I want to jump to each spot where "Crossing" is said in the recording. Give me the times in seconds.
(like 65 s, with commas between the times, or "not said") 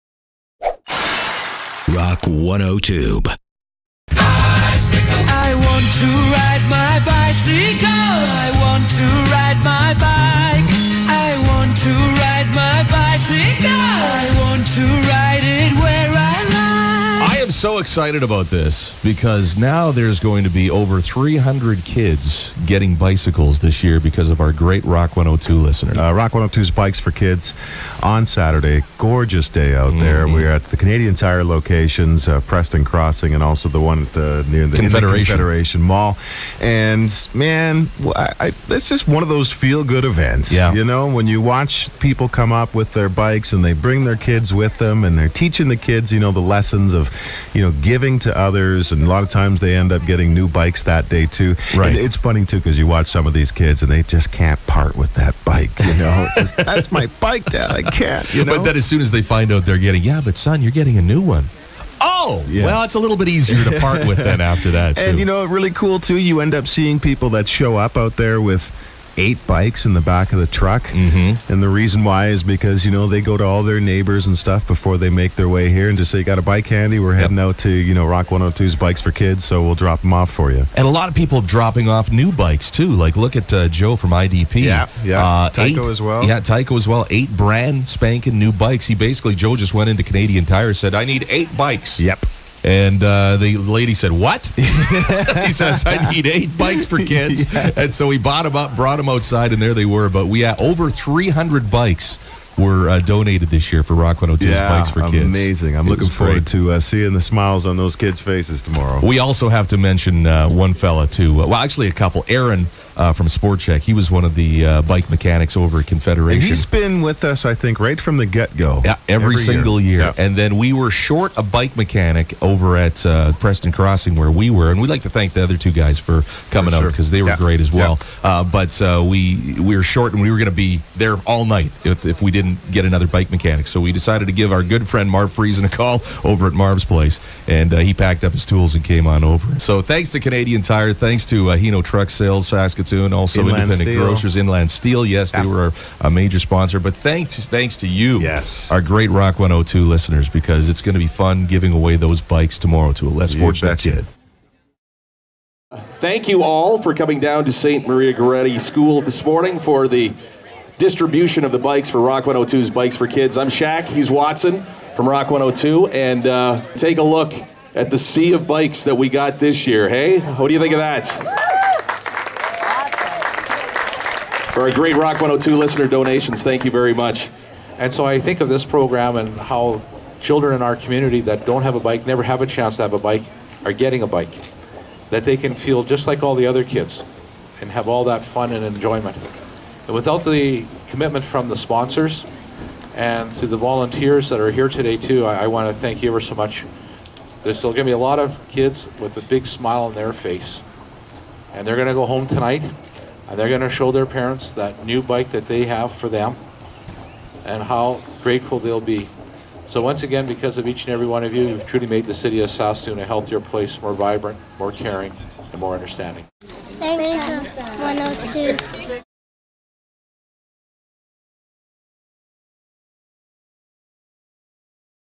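32 s, 123 s.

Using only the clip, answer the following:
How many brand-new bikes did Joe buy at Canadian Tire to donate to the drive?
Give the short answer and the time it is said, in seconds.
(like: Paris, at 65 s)
8, at 87 s.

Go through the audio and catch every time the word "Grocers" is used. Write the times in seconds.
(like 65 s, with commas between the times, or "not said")
144 s.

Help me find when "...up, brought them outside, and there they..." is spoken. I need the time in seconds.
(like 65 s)
98 s.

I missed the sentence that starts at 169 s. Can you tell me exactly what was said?
Hey, what do you think of that?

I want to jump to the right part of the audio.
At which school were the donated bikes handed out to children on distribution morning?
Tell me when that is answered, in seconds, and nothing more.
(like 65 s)
157 s.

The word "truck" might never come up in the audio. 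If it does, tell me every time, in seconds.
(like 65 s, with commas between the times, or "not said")
70 s, 141 s.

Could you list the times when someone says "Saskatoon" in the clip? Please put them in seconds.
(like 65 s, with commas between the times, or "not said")
142 s, 212 s.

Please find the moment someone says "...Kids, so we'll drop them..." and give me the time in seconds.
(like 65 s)
79 s.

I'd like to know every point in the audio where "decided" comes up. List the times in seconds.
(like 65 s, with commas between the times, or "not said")
133 s.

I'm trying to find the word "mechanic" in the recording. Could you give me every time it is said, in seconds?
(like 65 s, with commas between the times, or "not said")
115 s, 121 s, 133 s.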